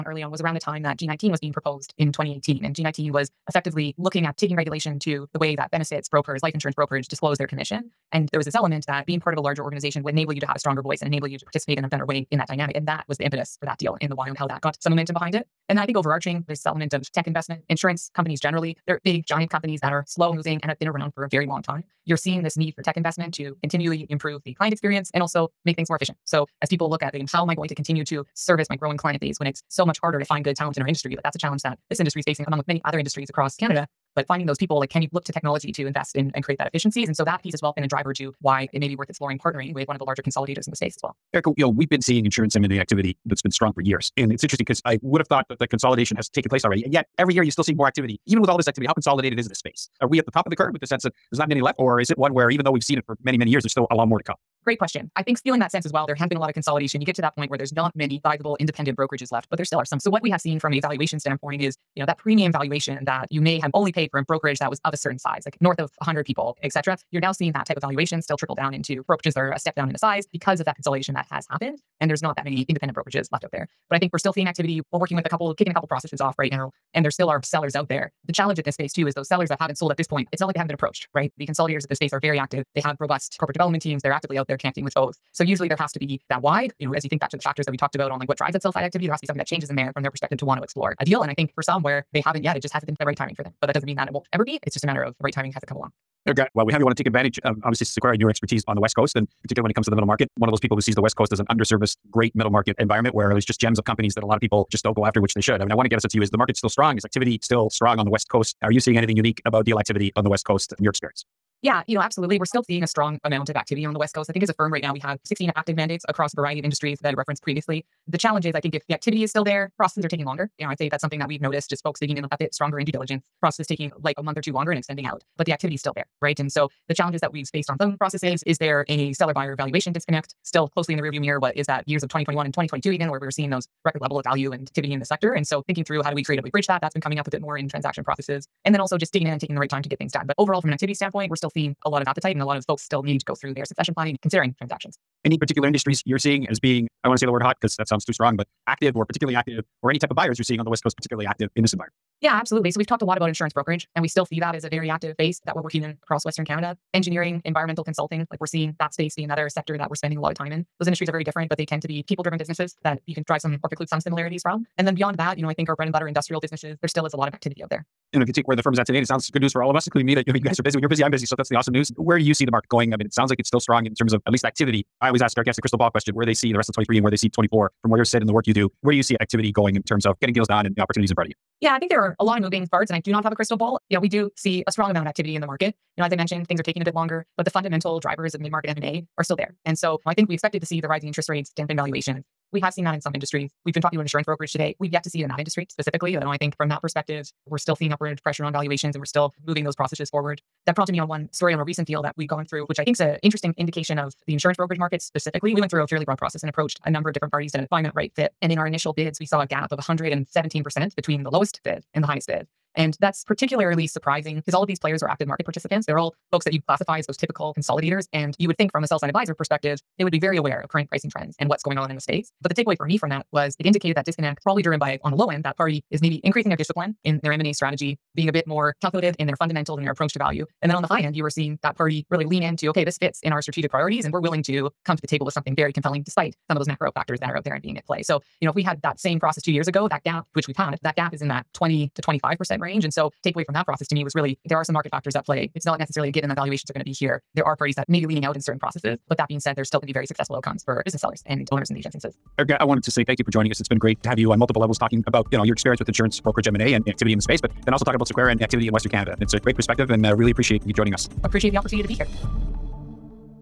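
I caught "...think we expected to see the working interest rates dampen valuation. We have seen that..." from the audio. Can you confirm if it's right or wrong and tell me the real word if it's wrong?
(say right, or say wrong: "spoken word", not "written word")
wrong: "rising", not "working".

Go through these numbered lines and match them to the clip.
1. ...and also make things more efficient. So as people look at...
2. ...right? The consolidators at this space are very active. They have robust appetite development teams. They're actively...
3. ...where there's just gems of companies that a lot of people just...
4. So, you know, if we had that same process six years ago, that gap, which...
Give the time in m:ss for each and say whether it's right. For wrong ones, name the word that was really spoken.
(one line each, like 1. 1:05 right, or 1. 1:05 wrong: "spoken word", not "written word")
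1. 0:25 right
2. 1:21 wrong: "corporate", not "appetite"
3. 1:43 right
4. 3:58 wrong: "two", not "six".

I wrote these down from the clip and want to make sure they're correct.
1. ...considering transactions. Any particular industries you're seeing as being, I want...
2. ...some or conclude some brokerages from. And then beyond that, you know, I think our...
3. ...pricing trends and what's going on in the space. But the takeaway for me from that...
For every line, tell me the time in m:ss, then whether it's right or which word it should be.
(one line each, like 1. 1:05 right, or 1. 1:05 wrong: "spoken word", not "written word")
1. 2:24 right
2. 2:43 wrong: "similarities", not "brokerages"
3. 3:40 right.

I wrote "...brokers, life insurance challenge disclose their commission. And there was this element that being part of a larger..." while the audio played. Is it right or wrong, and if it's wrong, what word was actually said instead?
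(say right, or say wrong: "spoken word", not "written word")
wrong: "brokerage", not "challenge".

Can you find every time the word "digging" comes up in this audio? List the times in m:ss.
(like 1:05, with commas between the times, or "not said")
2:01, 2:19.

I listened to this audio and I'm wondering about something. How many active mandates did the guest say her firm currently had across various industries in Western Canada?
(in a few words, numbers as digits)
16.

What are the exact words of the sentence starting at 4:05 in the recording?
It's not necessarily a given that valuations are going to be here.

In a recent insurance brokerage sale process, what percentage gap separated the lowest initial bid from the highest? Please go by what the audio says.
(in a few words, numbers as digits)
117%.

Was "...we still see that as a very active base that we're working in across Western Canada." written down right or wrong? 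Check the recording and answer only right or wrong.
right.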